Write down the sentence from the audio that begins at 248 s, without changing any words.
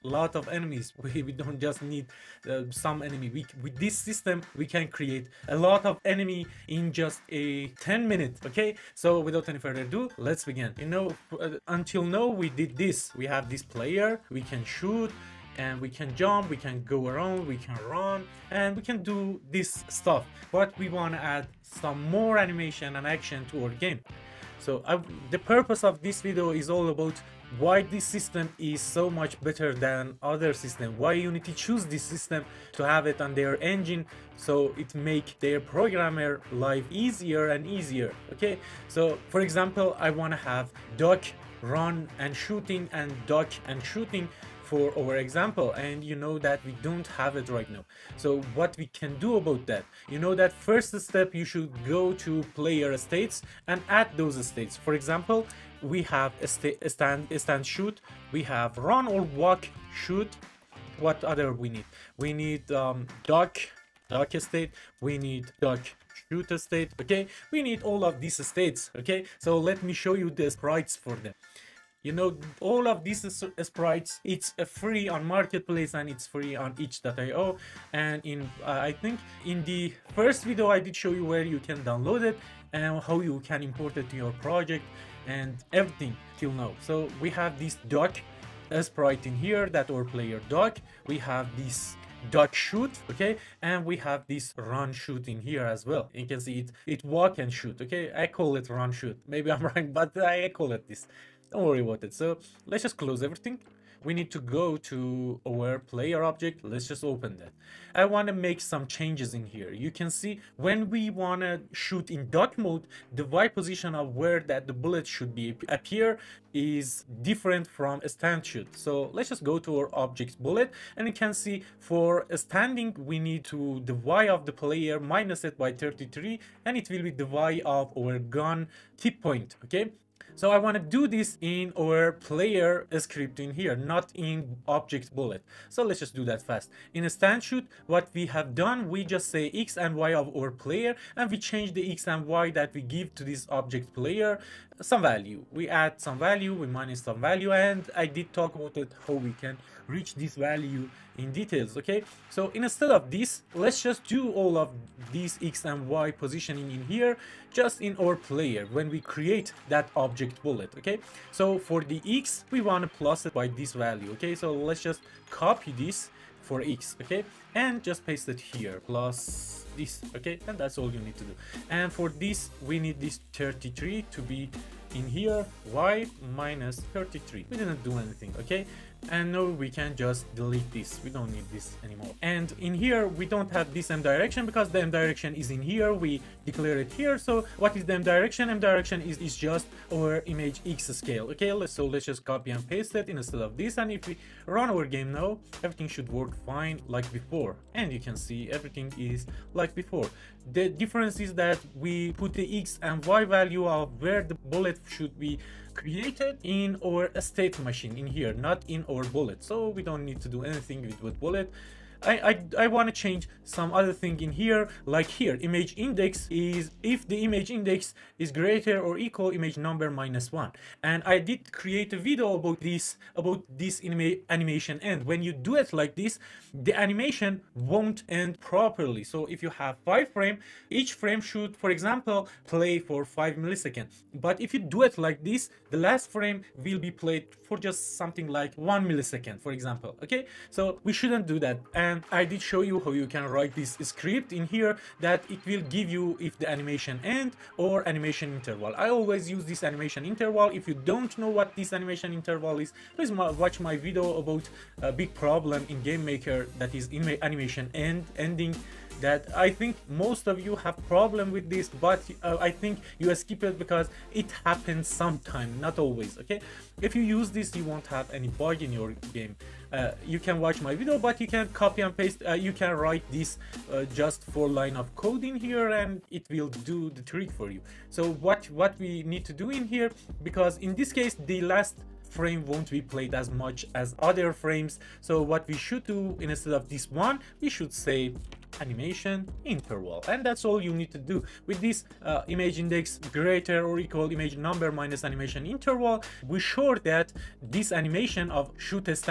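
I always use this animation interval.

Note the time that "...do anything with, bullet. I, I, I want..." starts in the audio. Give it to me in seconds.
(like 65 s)
210 s.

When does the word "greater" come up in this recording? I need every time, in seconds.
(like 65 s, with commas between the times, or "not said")
218 s, 293 s.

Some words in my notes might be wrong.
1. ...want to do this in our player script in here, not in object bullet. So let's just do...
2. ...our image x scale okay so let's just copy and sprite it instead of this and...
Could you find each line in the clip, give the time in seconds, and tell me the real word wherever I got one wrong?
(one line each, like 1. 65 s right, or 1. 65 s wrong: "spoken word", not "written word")
1. 130 s right
2. 189 s wrong: "paste", not "sprite".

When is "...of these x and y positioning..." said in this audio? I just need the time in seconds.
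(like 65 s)
154 s.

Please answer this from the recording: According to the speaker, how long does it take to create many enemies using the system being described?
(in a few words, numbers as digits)
10 minutes.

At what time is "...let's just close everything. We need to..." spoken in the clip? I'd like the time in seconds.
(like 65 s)
102 s.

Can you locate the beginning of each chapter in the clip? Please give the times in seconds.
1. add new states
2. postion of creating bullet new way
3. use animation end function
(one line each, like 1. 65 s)
1. 49 s
2. 107 s
3. 214 s.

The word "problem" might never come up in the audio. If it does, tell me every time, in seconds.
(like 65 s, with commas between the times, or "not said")
255 s, 260 s.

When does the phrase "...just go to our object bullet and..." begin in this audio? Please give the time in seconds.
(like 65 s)
119 s.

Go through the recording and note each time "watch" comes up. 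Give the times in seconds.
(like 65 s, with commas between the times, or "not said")
253 s, 270 s.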